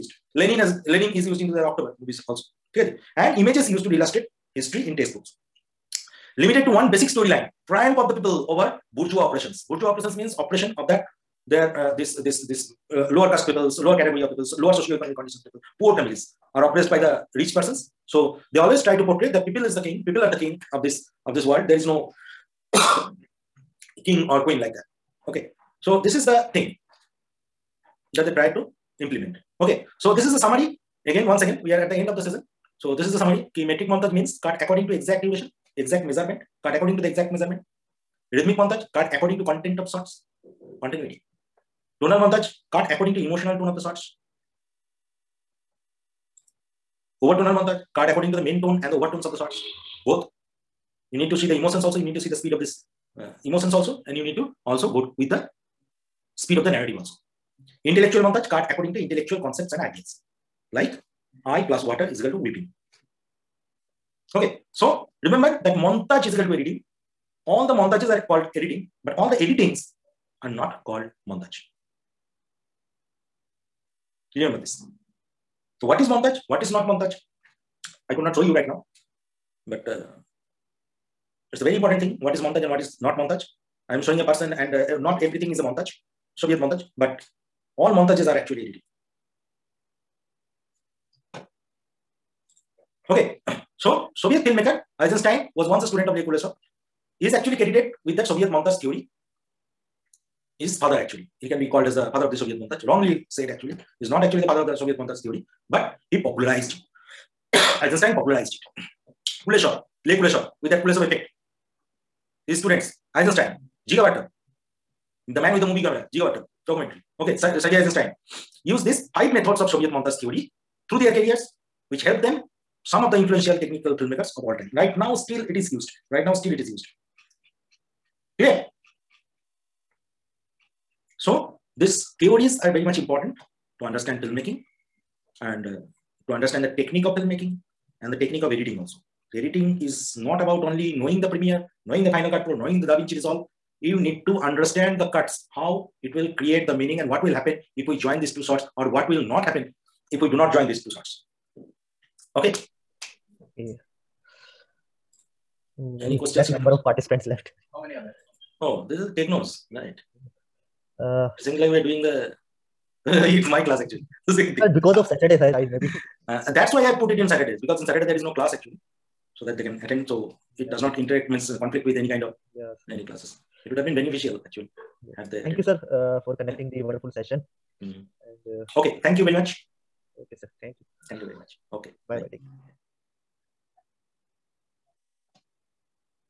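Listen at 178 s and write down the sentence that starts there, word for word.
and, uh, okay thank you very much okay sir thank you thank you very much okay bye bye, bye.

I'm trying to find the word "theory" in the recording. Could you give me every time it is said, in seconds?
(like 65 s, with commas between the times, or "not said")
98 s, 105 s, 120 s.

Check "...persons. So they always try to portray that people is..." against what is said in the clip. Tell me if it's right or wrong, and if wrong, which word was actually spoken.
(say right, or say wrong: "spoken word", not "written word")
right.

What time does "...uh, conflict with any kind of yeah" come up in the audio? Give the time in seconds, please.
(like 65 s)
171 s.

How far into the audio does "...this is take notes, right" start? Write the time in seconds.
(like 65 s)
158 s.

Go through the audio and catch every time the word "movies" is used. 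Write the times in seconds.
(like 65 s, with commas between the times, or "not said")
2 s, 115 s.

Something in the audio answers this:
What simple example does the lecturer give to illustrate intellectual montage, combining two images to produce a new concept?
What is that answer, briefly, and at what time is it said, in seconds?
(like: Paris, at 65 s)
eye plus water is equal to whipping, at 61 s.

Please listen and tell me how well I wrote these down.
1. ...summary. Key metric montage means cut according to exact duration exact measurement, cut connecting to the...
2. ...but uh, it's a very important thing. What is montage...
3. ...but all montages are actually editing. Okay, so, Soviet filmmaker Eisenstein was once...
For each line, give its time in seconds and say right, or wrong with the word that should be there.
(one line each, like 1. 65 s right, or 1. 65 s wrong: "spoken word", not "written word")
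1. 33 s wrong: "according", not "connecting"
2. 79 s right
3. 86 s right.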